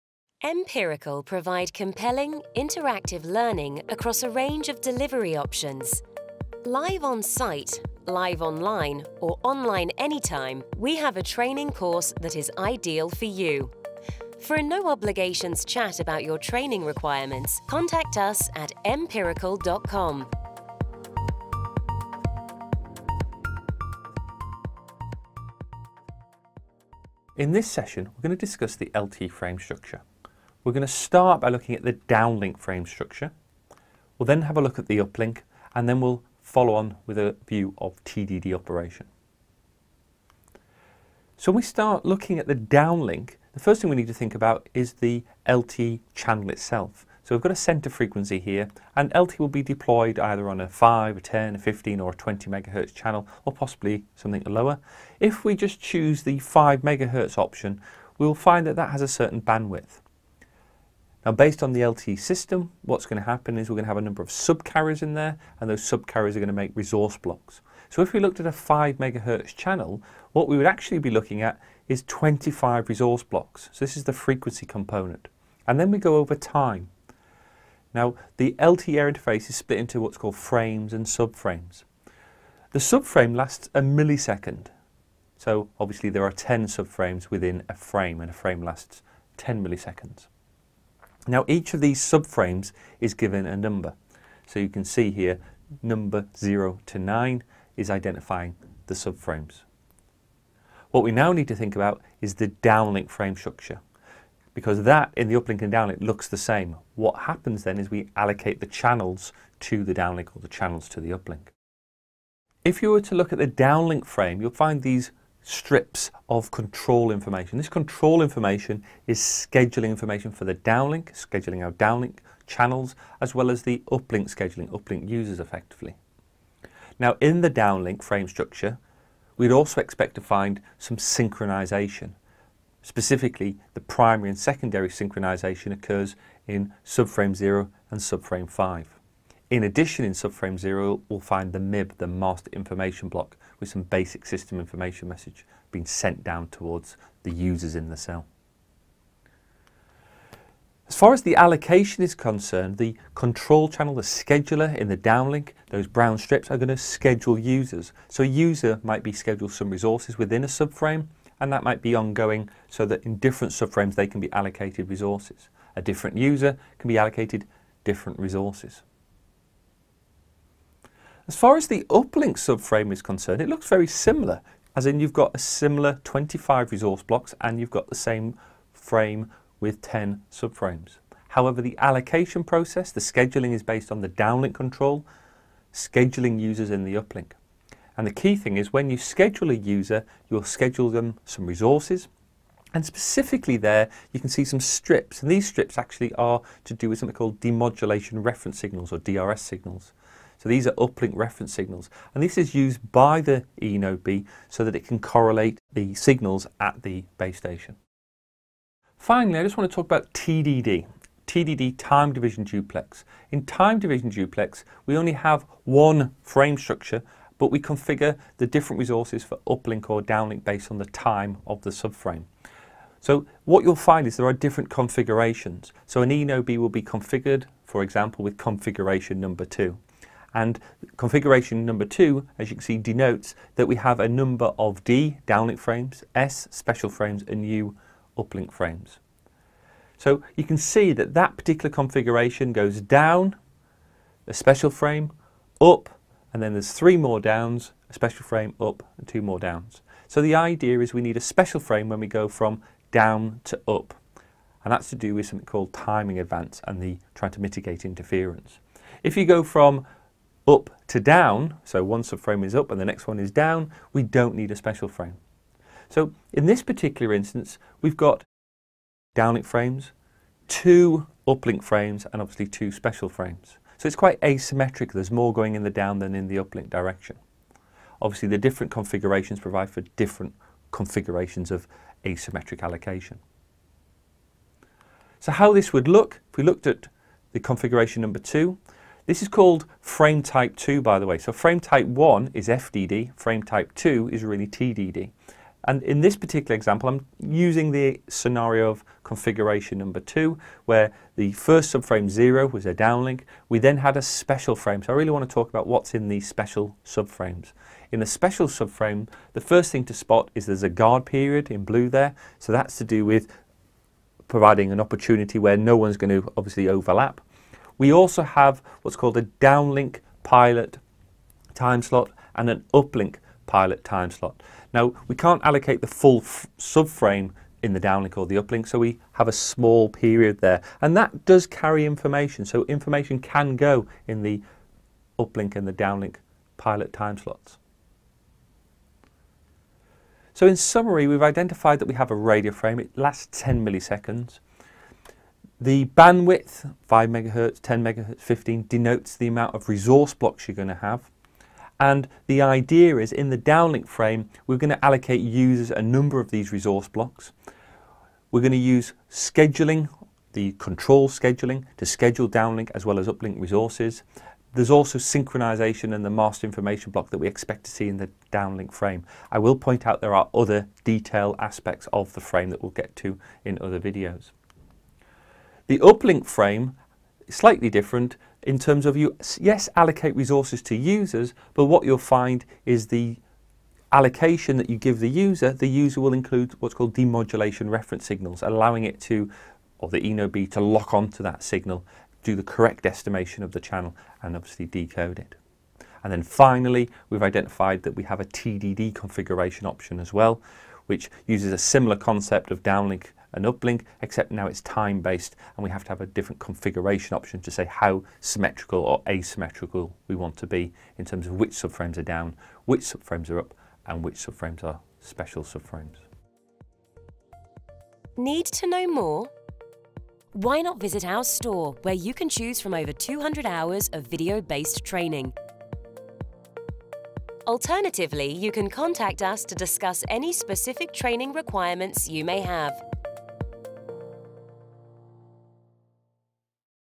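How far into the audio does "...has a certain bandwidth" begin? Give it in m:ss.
0:58.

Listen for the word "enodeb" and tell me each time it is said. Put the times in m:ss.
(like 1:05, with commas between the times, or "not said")
3:46, 6:30.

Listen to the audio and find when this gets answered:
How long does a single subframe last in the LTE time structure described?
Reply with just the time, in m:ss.
1:23.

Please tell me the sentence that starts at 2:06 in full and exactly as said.
Now in the downlink frame structure, we'd also expect to find some synchronization.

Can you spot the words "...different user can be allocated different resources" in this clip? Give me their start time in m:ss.
2:45.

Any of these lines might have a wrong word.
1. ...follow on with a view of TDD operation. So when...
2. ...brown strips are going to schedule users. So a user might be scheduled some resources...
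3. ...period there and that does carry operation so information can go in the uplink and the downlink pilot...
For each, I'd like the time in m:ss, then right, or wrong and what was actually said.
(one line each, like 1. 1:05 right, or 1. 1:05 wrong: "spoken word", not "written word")
1. 0:36 right
2. 2:35 right
3. 5:29 wrong: "information", not "operation".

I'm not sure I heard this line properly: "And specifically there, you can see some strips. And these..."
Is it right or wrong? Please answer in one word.
right.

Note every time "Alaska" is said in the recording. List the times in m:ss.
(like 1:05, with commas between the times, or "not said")
not said.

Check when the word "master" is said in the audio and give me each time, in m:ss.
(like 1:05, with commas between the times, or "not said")
2:22, 6:06.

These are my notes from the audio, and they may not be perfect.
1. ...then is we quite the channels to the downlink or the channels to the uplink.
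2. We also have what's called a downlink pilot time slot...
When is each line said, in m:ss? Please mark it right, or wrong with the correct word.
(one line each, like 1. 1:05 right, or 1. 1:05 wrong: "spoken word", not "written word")
1. 1:47 wrong: "allocate", not "quite"
2. 5:17 right.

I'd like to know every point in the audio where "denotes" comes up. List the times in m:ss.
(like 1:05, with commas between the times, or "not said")
3:52, 5:48.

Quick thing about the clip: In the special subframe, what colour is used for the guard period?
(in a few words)
Blue.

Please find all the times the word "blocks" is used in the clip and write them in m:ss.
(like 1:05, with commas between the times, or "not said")
1:07, 1:13, 2:23, 2:57, 5:50, 5:56, 6:06.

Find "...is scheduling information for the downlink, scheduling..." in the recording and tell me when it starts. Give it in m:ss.
1:59.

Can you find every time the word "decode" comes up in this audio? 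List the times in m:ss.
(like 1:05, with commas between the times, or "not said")
6:34.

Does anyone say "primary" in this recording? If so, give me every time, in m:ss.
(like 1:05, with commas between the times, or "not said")
2:13.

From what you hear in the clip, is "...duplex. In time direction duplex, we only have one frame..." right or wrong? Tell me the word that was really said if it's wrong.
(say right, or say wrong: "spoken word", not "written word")
wrong: "division", not "direction".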